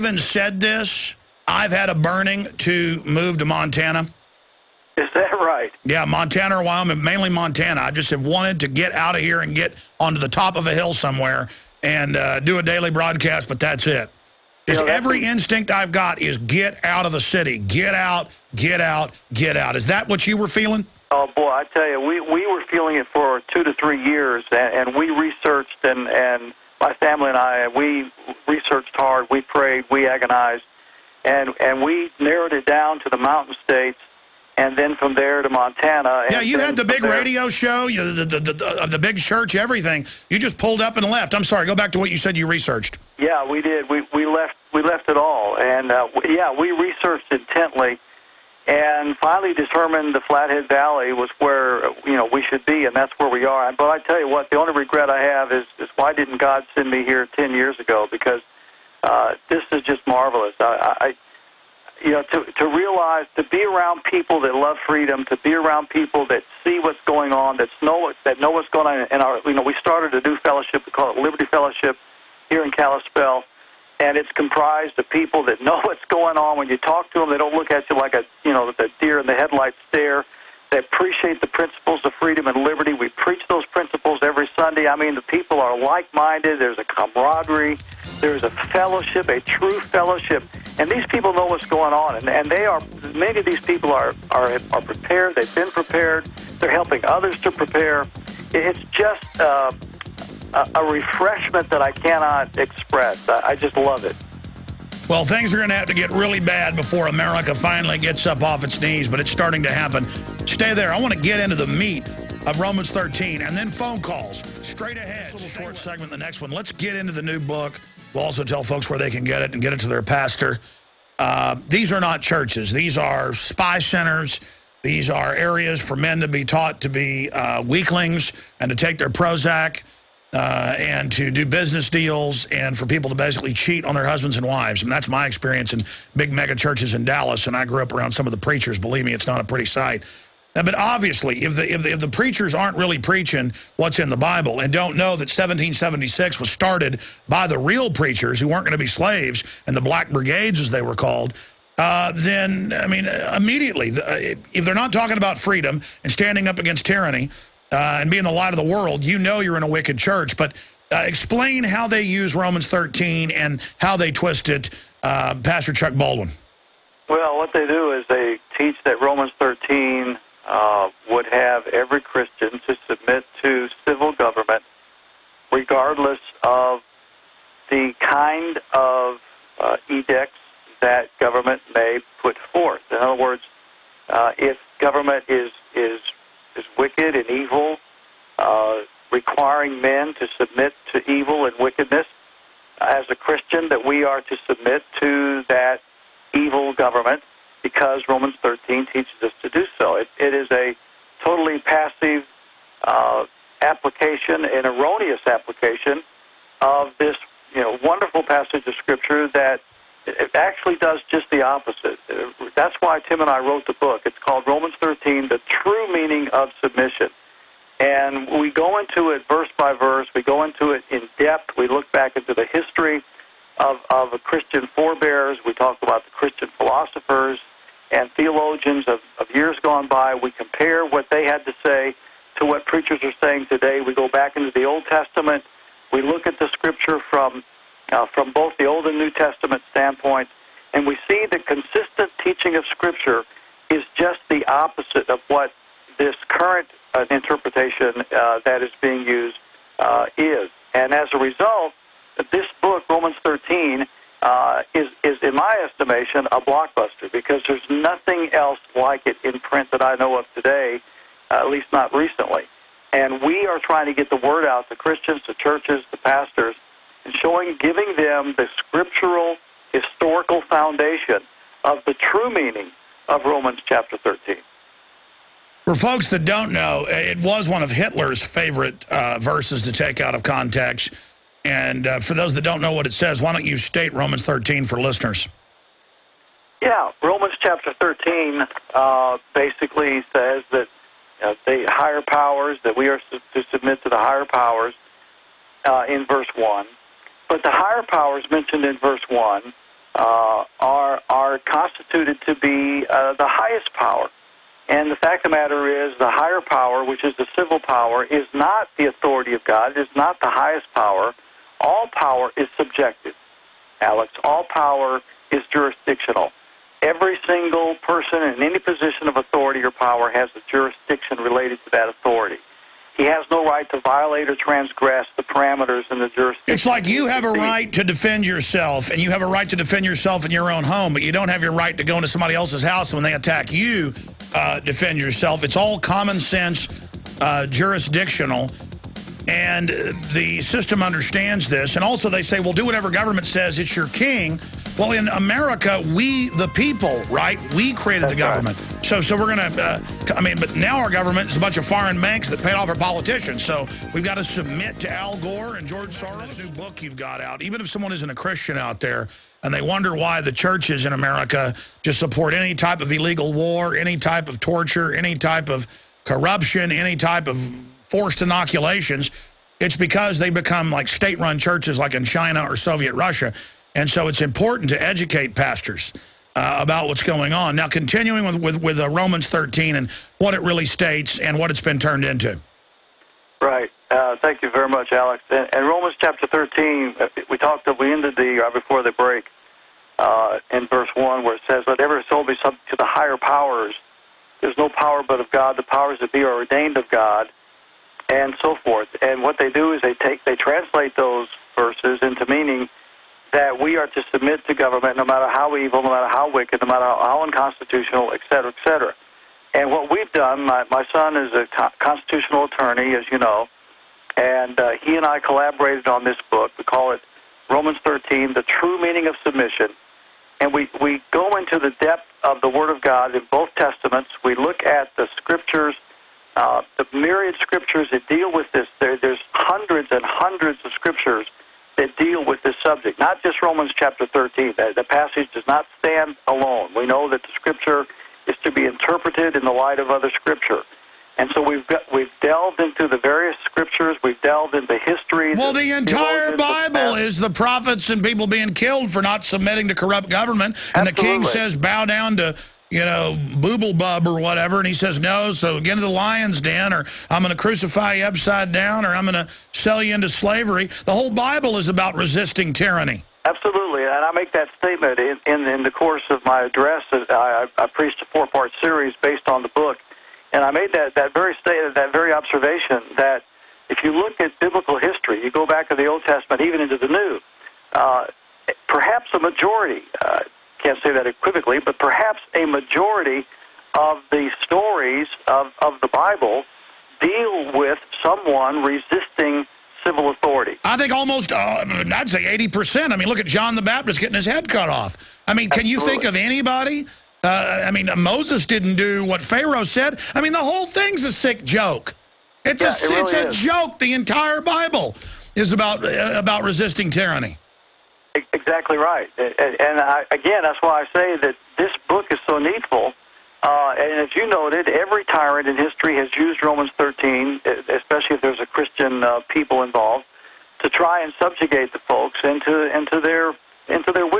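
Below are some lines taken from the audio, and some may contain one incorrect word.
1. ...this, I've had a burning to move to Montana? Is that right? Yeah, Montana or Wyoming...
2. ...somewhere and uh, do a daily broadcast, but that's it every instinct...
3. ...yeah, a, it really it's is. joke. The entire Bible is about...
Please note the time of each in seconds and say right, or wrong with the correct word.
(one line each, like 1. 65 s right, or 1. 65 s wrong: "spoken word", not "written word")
1. 0 s right
2. 10 s right
3. 502 s right.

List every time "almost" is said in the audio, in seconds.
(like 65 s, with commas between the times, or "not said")
490 s.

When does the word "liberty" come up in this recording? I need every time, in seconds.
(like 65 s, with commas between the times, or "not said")
71 s, 82 s.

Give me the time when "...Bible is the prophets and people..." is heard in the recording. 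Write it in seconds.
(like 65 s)
446 s.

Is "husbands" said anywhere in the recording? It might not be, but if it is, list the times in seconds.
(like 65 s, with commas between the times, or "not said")
134 s.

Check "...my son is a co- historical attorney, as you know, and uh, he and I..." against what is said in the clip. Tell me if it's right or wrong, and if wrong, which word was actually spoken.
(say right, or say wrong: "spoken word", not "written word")
wrong: "constitutional", not "historical".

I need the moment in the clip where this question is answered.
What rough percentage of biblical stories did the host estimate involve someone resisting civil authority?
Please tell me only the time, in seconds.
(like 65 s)
492 s.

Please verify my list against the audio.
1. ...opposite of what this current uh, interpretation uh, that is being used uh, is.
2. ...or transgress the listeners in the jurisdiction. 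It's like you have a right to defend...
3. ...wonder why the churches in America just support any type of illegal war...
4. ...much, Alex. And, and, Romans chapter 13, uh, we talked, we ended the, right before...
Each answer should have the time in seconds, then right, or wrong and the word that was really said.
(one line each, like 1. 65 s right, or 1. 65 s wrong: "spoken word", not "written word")
1. 244 s right
2. 324 s wrong: "parameters", not "listeners"
3. 359 s right
4. 384 s right.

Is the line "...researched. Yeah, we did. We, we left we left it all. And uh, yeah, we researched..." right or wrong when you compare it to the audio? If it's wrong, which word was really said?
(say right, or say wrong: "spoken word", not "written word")
right.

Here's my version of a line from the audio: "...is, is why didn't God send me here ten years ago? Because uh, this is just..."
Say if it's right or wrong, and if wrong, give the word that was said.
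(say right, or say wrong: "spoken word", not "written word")
right.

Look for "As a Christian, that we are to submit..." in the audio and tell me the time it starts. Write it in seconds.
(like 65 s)
192 s.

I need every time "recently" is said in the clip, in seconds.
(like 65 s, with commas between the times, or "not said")
261 s.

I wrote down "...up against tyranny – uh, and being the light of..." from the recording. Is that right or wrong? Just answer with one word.
right.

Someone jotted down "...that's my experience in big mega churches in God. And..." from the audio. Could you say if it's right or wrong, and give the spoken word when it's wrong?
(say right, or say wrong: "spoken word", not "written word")
wrong: "Dallas", not "God".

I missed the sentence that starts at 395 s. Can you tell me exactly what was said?
The powers that be are ordained of God, and so forth.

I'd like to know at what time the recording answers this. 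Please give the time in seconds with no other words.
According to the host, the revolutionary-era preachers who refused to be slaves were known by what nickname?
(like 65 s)
149 s.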